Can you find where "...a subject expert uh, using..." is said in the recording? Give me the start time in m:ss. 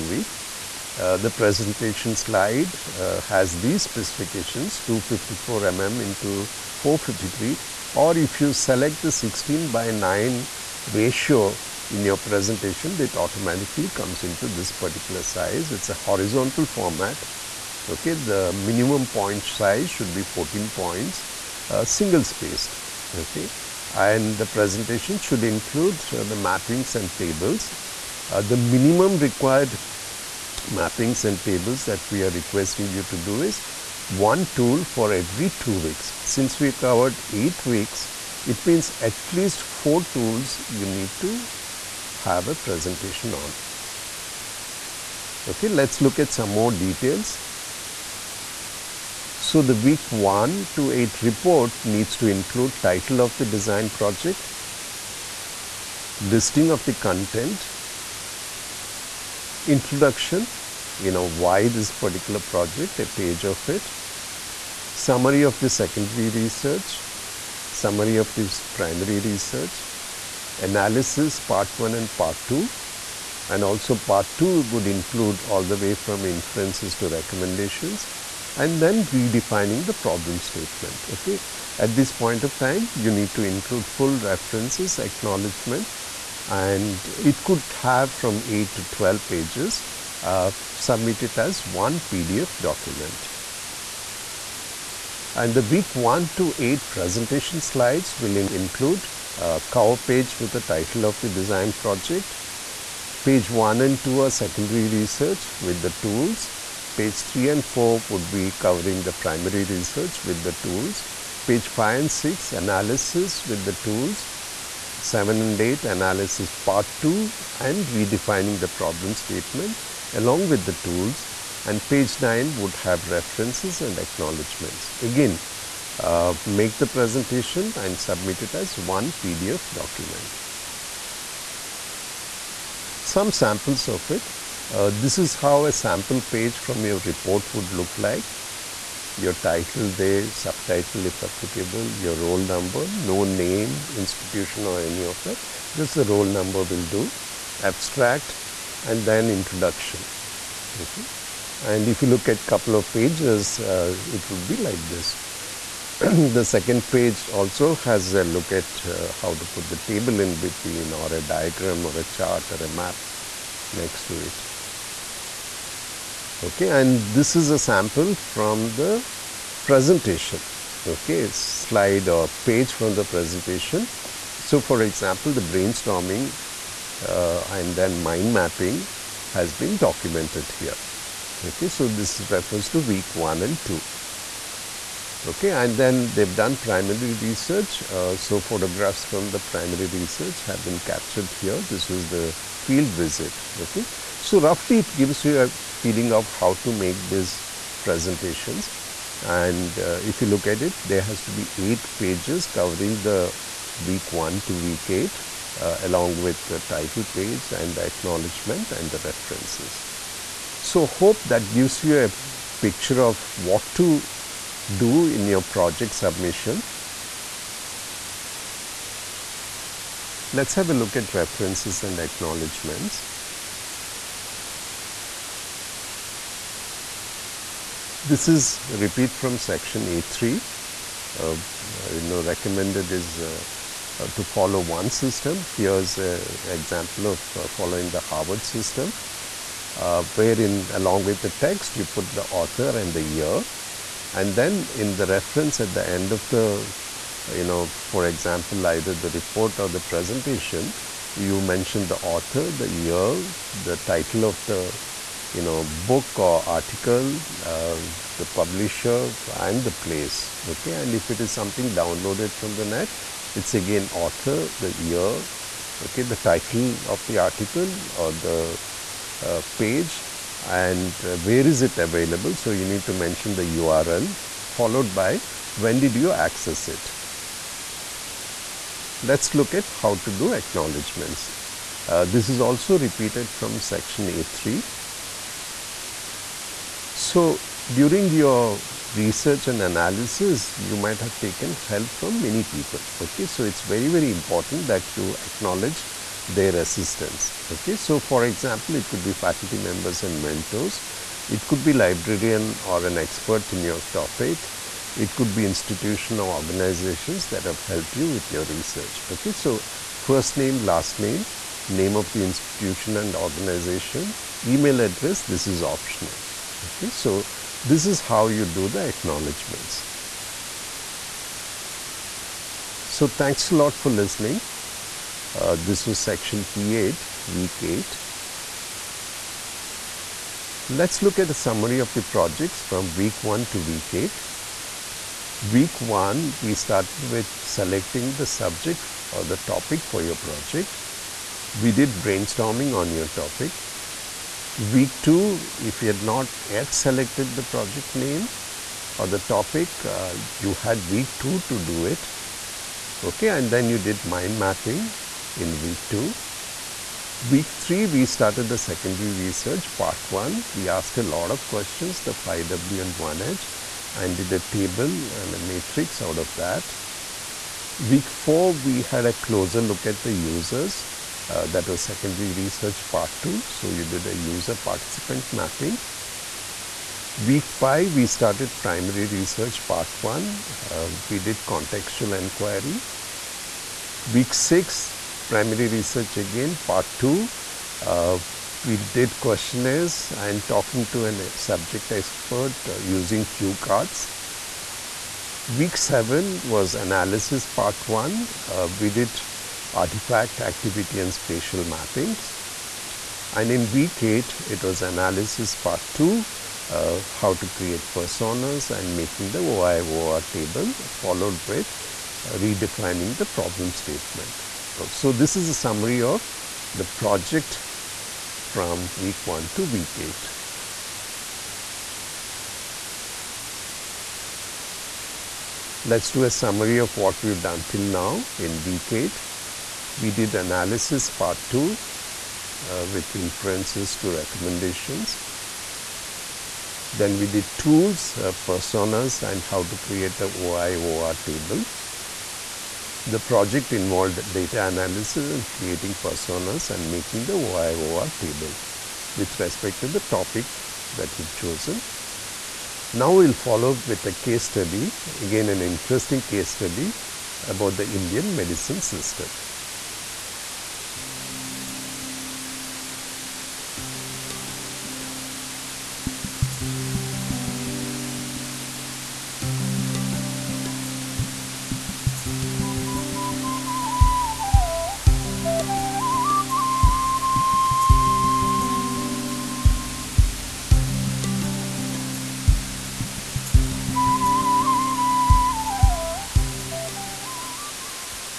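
6:31.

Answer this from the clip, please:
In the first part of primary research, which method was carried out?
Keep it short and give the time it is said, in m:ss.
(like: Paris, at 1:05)
Contextual inquiry, at 6:21.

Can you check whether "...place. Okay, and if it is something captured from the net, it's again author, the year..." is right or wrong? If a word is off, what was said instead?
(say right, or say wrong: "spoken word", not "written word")
wrong: "downloaded", not "captured".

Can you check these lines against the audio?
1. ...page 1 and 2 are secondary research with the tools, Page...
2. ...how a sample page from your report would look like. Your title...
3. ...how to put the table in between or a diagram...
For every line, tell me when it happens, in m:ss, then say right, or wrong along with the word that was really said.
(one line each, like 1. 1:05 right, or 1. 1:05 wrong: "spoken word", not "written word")
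1. 1:43 right
2. 2:15 right
3. 2:39 right.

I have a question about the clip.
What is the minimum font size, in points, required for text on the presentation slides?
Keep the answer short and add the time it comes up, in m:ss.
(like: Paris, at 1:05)
14, at 0:20.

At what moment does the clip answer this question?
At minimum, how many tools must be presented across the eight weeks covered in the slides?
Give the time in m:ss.
0:39.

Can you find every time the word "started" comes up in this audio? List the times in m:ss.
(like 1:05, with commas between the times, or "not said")
5:36, 5:58, 6:18.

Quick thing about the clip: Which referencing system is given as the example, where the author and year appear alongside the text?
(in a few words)
Harvard system.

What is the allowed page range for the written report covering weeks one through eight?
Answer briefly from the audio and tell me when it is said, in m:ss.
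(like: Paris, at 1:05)
8 to 12 pages, at 1:28.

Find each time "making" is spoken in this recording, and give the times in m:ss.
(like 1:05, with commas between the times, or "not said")
6:48, 7:26.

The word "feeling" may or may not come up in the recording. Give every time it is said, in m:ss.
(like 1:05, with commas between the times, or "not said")
3:15.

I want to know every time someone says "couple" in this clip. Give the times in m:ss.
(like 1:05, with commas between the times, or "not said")
2:32.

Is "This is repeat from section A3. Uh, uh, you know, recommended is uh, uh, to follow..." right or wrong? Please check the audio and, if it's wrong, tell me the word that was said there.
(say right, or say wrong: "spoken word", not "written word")
right.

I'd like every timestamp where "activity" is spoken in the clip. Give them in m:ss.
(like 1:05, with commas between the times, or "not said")
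6:40.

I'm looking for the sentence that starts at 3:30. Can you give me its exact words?
So, hope that gives you a picture of what to do in your project submission.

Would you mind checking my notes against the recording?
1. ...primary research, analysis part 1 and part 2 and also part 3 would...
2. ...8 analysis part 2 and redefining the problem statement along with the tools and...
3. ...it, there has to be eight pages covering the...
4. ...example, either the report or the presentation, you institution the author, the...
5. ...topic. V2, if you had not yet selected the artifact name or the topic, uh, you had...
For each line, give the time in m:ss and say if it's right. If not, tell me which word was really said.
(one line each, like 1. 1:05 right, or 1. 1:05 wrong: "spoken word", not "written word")
1. 1:08 wrong: "2", not "3"
2. 1:55 right
3. 3:20 right
4. 4:08 wrong: "mention", not "institution"
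5. 5:43 wrong: "project", not "artifact".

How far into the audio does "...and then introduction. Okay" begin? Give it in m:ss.
2:28.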